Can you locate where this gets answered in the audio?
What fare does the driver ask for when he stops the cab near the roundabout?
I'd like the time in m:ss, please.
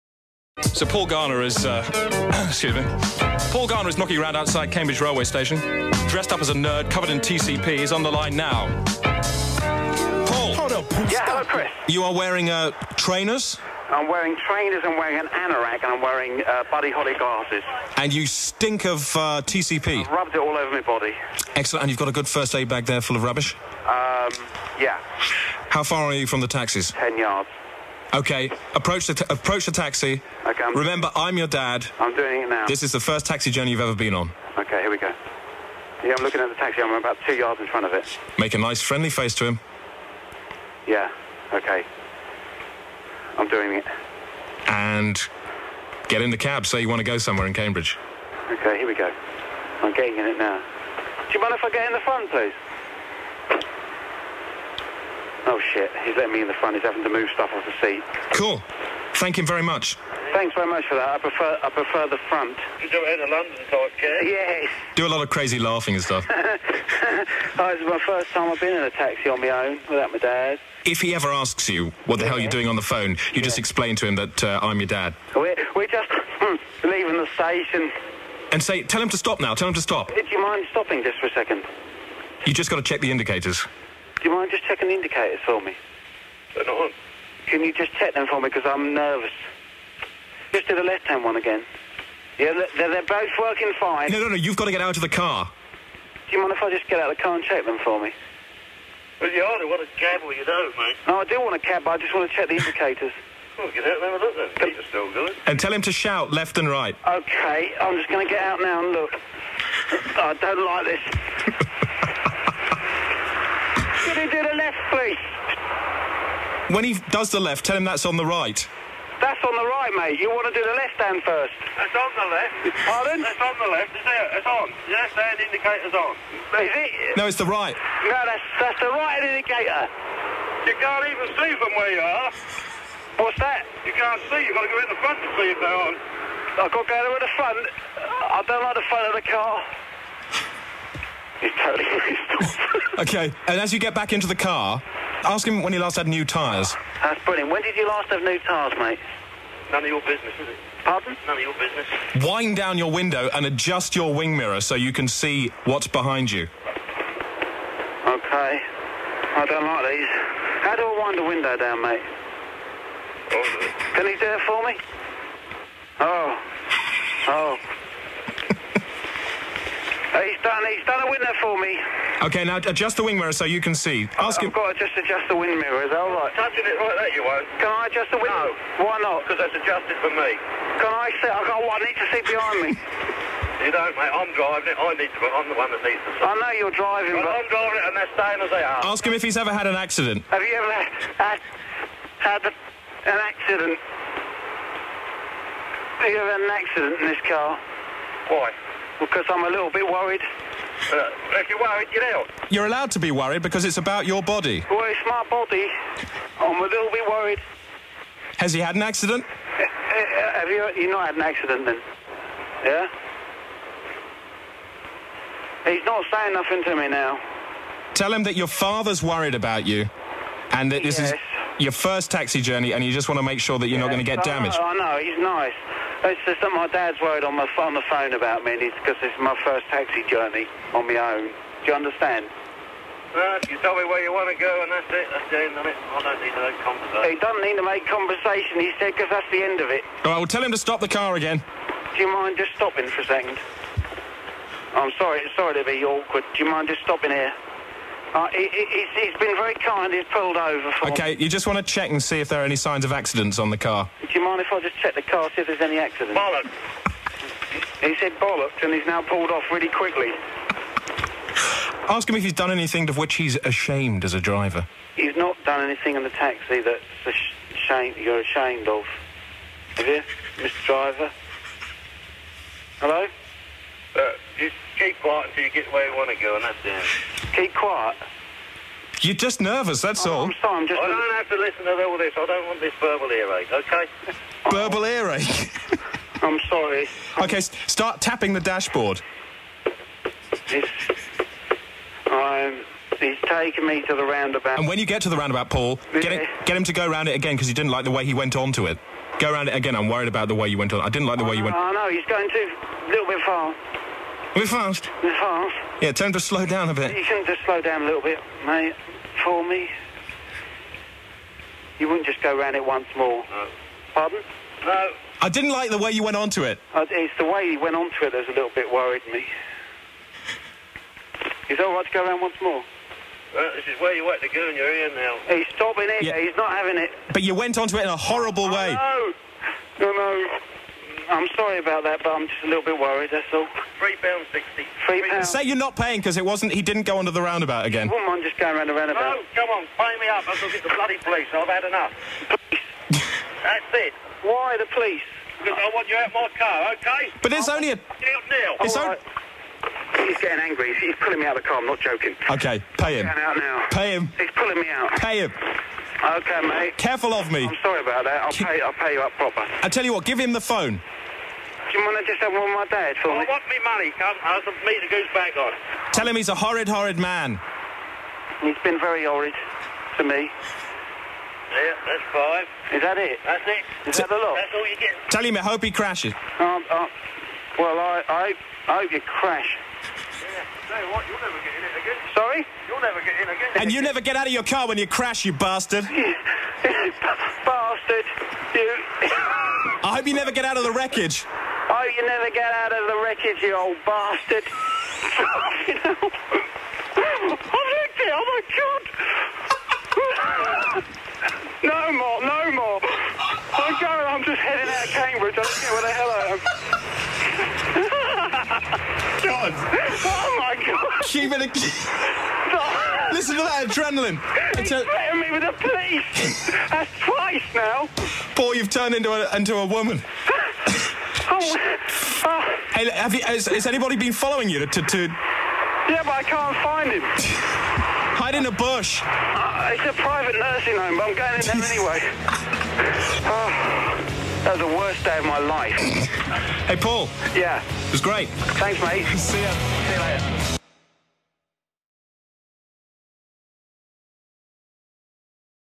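5:33.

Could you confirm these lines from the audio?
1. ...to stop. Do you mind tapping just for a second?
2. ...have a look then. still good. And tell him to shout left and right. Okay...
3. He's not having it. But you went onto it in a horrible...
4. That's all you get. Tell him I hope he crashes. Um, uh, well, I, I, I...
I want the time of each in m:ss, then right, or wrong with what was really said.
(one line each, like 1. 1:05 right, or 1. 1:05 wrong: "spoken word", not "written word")
1. 1:19 wrong: "stopping", not "tapping"
2. 1:44 right
3. 5:26 right
4. 6:14 right.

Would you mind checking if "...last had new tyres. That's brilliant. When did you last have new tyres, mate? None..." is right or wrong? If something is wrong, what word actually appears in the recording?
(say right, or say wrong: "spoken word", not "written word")
right.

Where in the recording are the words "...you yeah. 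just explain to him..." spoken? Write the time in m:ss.
1:13.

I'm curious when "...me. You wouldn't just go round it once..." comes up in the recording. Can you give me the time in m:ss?
5:09.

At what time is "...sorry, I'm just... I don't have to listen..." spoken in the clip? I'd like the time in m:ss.
4:40.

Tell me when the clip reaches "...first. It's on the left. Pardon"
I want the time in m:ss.
2:01.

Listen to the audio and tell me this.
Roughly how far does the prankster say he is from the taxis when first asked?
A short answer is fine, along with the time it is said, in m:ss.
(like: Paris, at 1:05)
10 yards, at 0:26.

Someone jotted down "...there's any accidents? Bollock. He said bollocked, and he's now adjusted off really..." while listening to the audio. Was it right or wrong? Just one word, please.
wrong.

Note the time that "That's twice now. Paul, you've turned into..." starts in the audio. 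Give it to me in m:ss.
6:56.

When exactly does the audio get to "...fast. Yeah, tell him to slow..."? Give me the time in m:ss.
5:05.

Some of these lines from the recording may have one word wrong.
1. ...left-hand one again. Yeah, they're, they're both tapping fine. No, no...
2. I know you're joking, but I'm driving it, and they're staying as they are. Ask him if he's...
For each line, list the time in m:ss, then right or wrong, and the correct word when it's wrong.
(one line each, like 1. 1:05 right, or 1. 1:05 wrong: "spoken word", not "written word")
1. 1:30 wrong: "working", not "tapping"
2. 3:06 wrong: "driving", not "joking".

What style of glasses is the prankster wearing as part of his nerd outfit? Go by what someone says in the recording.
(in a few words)
Buddy Holly glasses.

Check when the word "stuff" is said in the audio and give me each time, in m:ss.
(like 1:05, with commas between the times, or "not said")
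0:57, 1:06.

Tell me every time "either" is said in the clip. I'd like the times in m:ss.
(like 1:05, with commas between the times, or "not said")
1:39.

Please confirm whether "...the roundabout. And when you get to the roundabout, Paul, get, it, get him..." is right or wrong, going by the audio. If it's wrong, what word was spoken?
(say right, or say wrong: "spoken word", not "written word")
right.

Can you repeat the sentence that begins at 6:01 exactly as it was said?
Do you want I just have one more I want me money, I goose back on.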